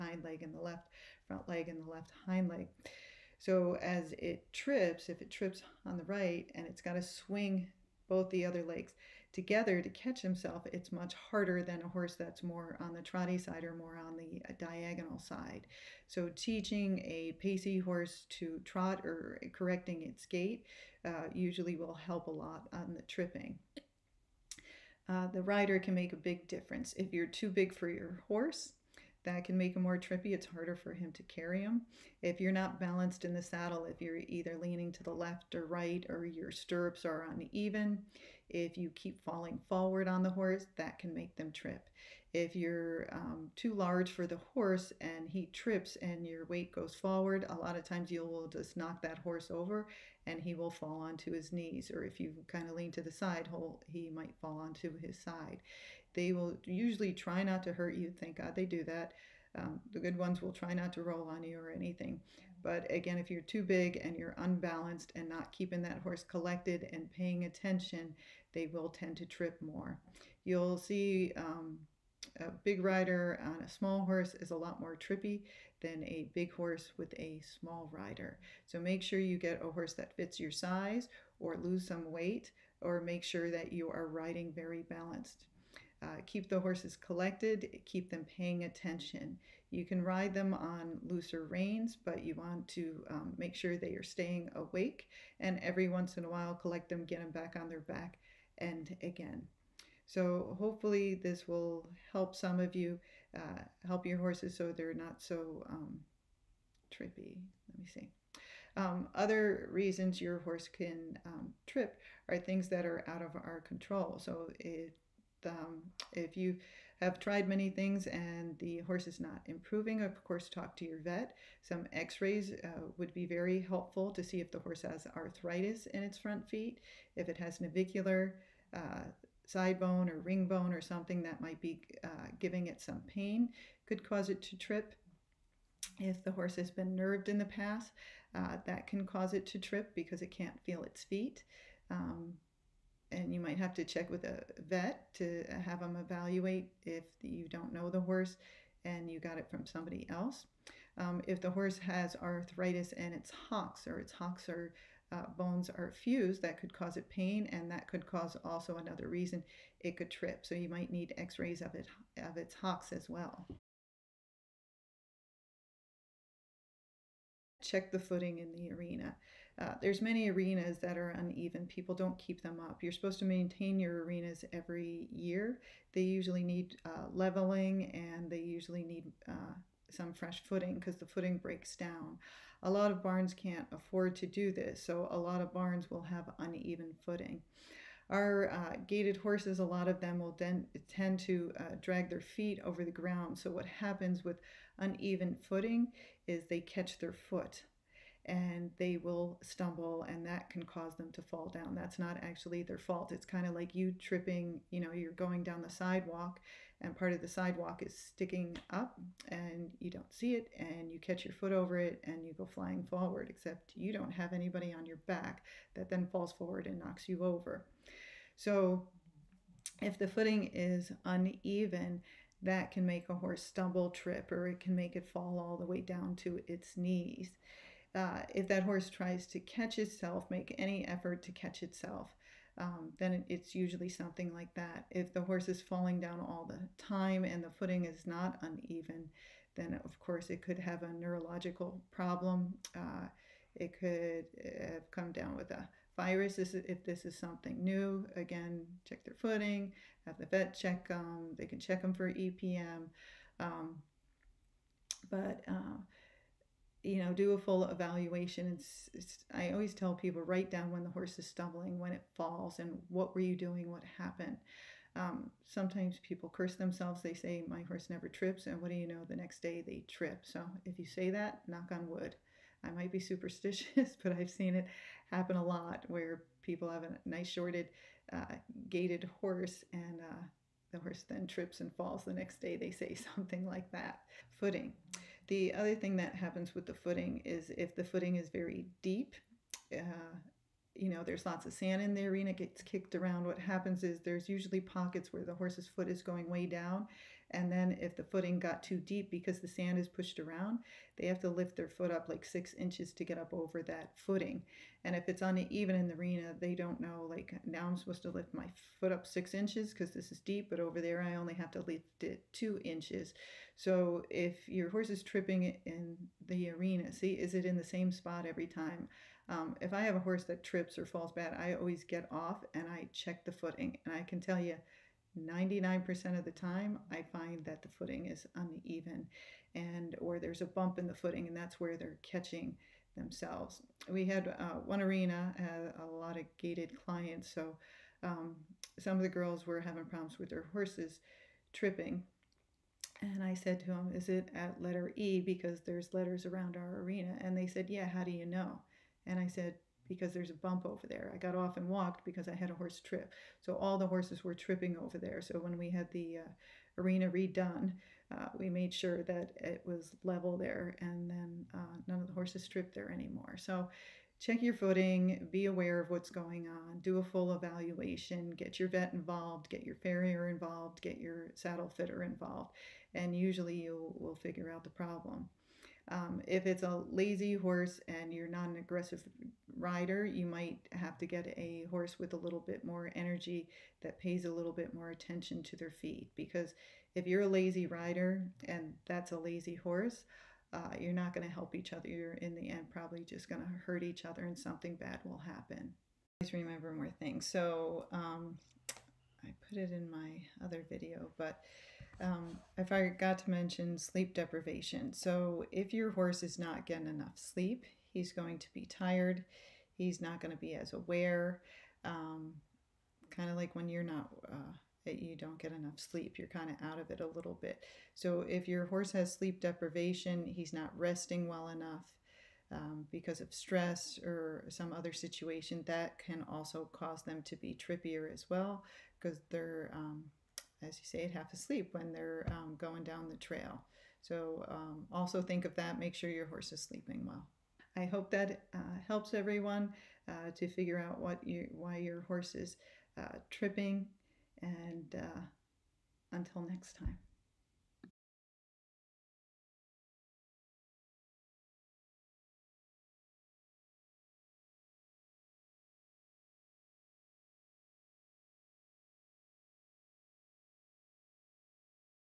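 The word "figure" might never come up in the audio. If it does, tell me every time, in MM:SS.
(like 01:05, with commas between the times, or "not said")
06:14, 07:20.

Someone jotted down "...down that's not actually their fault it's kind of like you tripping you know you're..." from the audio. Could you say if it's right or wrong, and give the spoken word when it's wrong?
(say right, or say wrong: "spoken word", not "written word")
right.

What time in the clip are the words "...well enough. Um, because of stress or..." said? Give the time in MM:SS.
07:01.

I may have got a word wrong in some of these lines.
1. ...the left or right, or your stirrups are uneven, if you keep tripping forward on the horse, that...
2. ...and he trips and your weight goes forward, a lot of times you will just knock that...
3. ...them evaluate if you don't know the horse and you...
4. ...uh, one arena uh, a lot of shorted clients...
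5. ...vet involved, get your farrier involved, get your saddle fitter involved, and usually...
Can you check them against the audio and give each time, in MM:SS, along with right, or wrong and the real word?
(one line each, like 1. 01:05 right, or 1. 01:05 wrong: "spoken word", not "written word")
1. 00:35 wrong: "falling", not "tripping"
2. 00:45 right
3. 02:25 right
4. 05:34 wrong: "gaited", not "shorted"
5. 06:08 right.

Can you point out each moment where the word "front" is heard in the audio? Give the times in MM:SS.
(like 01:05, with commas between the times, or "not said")
00:01, 02:06.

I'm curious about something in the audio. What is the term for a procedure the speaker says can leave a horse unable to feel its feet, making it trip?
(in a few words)
nerved.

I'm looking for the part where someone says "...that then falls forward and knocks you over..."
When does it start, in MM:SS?
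03:35.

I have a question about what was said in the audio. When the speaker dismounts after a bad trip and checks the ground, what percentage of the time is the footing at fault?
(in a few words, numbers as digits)
99%.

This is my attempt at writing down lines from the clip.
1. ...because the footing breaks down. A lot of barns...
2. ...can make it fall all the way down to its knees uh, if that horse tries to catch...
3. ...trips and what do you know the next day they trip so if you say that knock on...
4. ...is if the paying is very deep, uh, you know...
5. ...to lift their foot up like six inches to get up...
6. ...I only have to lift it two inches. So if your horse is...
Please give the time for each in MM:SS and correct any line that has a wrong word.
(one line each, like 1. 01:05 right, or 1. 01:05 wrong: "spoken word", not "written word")
1. 03:00 right
2. 03:44 right
3. 04:28 right
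4. 04:47 wrong: "footing", not "paying"
5. 05:01 right
6. 05:11 right.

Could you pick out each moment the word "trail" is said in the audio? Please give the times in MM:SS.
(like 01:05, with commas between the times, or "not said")
07:13.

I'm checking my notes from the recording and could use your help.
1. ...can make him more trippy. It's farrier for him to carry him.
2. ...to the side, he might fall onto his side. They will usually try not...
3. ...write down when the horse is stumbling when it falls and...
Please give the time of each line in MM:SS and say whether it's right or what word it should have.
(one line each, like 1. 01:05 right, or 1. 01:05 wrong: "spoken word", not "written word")
1. 00:29 wrong: "harder", not "farrier"
2. 00:52 right
3. 04:20 right.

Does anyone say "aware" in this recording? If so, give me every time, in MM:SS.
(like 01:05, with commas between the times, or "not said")
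06:05, 06:50.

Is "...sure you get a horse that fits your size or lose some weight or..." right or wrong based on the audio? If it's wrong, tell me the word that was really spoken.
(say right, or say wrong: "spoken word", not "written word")
right.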